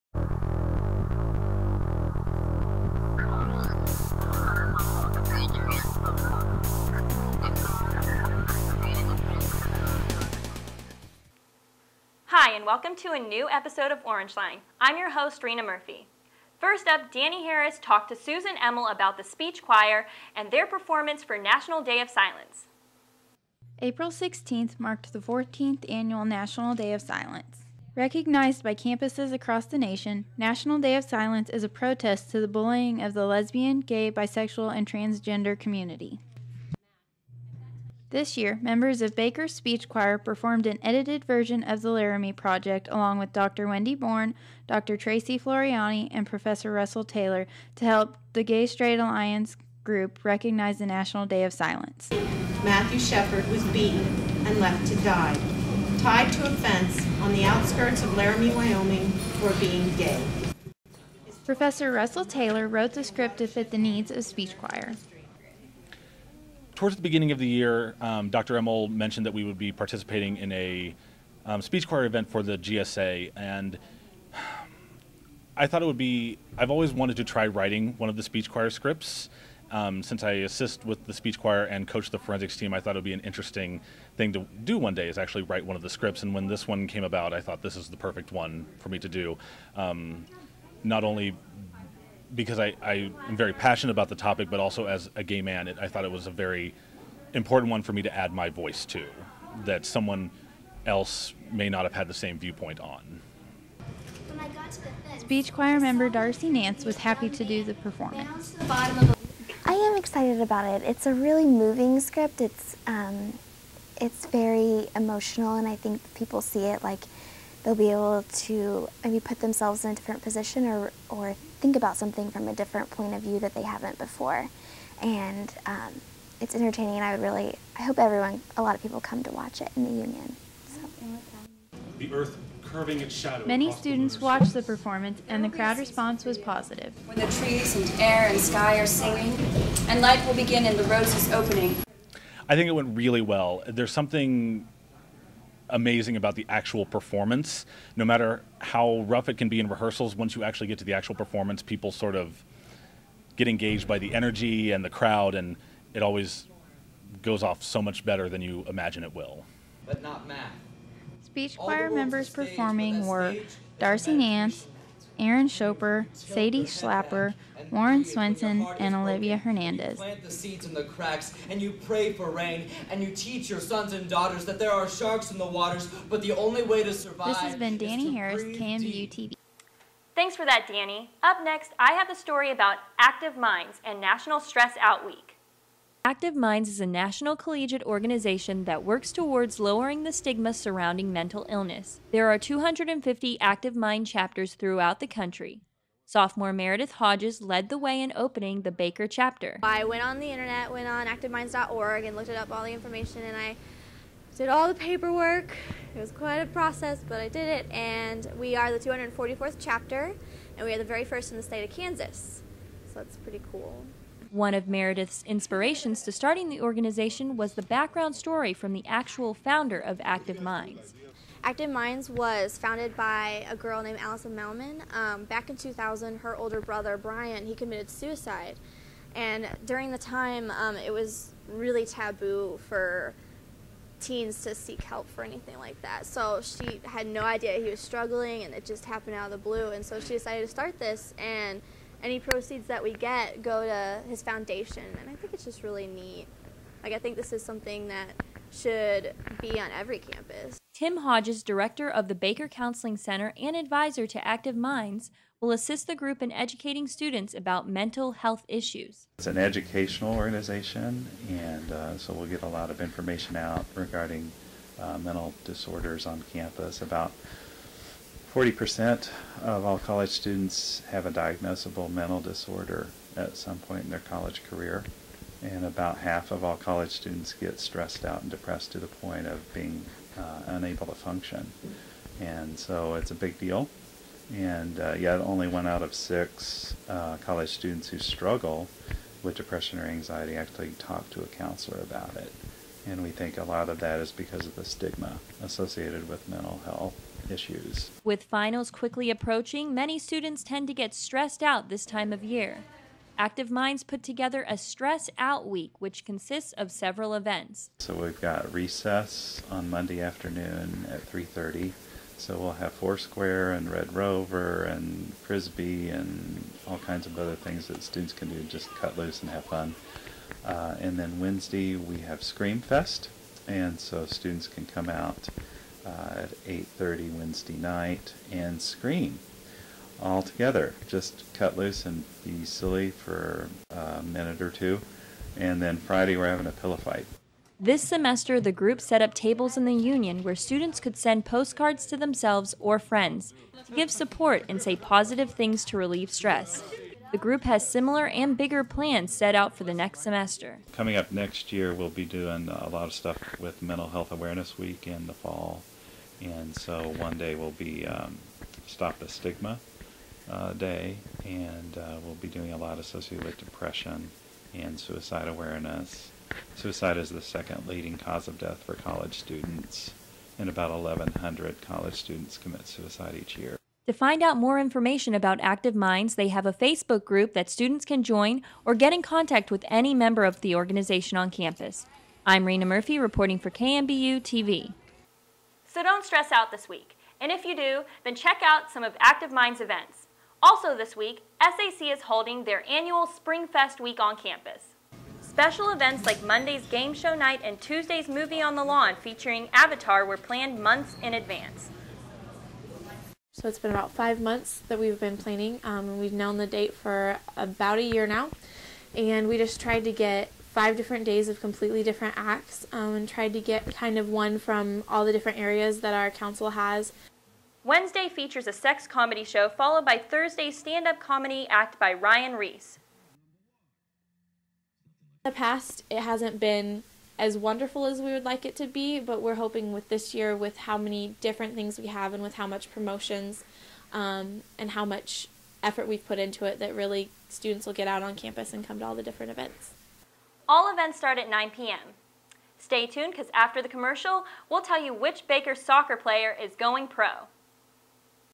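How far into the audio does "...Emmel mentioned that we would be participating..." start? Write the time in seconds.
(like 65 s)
68 s.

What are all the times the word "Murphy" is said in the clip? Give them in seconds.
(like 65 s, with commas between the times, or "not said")
15 s, 382 s.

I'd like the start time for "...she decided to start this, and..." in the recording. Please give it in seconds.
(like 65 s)
239 s.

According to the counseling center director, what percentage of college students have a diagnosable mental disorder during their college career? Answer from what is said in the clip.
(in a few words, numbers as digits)
40%.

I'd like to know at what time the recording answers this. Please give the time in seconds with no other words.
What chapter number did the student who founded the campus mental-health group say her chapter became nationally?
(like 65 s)
208 s.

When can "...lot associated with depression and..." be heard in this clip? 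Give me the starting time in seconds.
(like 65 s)
362 s.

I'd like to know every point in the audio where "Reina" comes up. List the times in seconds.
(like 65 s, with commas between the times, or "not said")
15 s, 382 s.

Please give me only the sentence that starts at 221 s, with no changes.
Active Minds was founded by a girl named Alison Malmon.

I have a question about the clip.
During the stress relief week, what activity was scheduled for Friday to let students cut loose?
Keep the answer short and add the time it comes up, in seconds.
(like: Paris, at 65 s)
pillow fight, at 336 s.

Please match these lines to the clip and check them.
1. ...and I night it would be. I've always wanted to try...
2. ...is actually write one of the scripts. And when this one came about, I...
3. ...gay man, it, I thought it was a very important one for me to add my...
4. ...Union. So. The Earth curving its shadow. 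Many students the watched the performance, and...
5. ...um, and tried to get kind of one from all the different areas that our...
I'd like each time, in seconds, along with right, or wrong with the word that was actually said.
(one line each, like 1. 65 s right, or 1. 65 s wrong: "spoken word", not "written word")
1. 73 s wrong: "thought", not "night"
2. 85 s right
3. 95 s right
4. 129 s right
5. 412 s right.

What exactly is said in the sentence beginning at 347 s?
The group has similar and bigger plans set out for the next semester.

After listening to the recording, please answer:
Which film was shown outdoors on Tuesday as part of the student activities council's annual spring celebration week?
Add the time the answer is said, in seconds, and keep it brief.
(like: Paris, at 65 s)
Avatar, at 399 s.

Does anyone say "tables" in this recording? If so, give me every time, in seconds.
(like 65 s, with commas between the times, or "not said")
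339 s.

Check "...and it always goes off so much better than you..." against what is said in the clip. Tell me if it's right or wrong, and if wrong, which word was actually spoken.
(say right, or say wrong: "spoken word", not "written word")
right.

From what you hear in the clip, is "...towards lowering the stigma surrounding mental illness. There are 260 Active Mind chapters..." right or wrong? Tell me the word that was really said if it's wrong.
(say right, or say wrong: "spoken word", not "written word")
wrong: "250", not "260".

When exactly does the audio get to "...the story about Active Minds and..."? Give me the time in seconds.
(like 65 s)
182 s.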